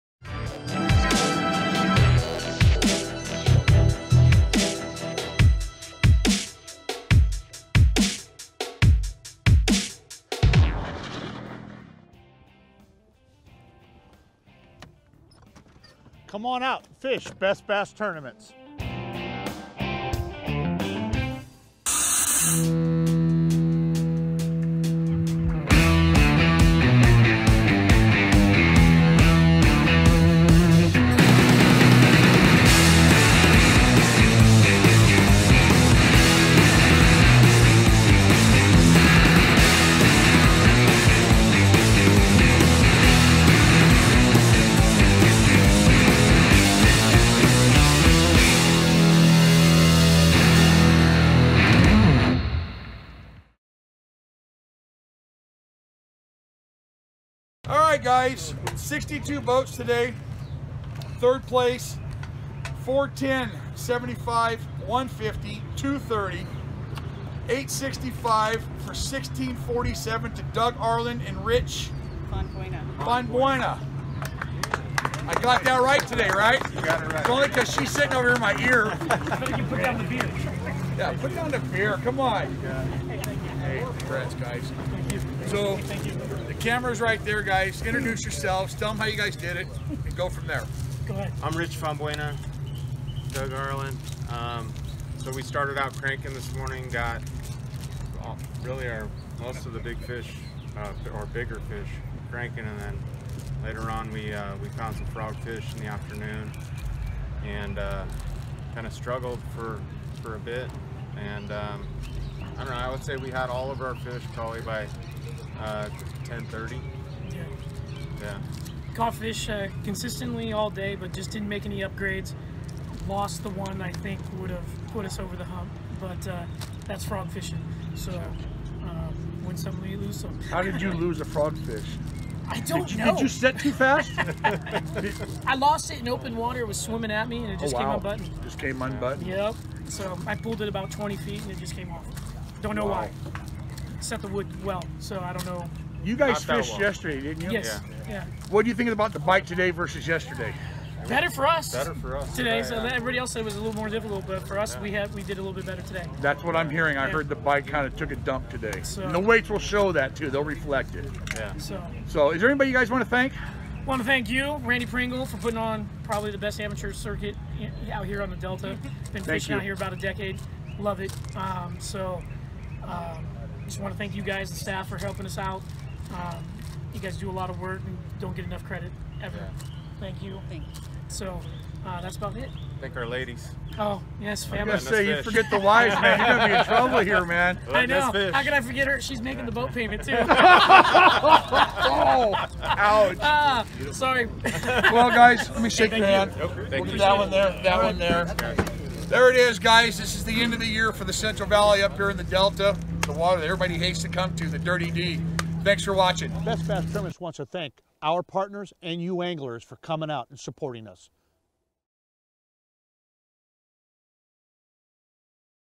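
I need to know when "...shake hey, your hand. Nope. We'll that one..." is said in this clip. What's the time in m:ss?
3:15.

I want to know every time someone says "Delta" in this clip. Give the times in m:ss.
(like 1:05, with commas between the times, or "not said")
2:48, 3:22.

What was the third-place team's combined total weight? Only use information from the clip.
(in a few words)
1647.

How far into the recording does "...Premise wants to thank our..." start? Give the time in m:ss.
3:26.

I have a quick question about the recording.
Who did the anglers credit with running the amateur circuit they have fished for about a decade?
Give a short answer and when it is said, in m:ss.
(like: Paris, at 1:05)
Randy Pringle, at 2:44.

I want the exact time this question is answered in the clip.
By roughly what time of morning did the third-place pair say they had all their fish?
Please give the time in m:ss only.
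1:56.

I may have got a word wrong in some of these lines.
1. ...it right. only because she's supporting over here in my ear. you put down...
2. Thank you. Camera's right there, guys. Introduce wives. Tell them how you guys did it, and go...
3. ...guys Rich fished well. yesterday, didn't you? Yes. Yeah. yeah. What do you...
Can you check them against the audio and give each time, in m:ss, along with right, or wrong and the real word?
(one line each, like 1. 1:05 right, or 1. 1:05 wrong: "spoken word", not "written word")
1. 1:17 wrong: "sitting", not "supporting"
2. 1:25 wrong: "yourselves", not "wives"
3. 2:26 wrong: "Not", not "Rich".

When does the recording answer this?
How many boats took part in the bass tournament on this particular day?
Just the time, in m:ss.
0:58.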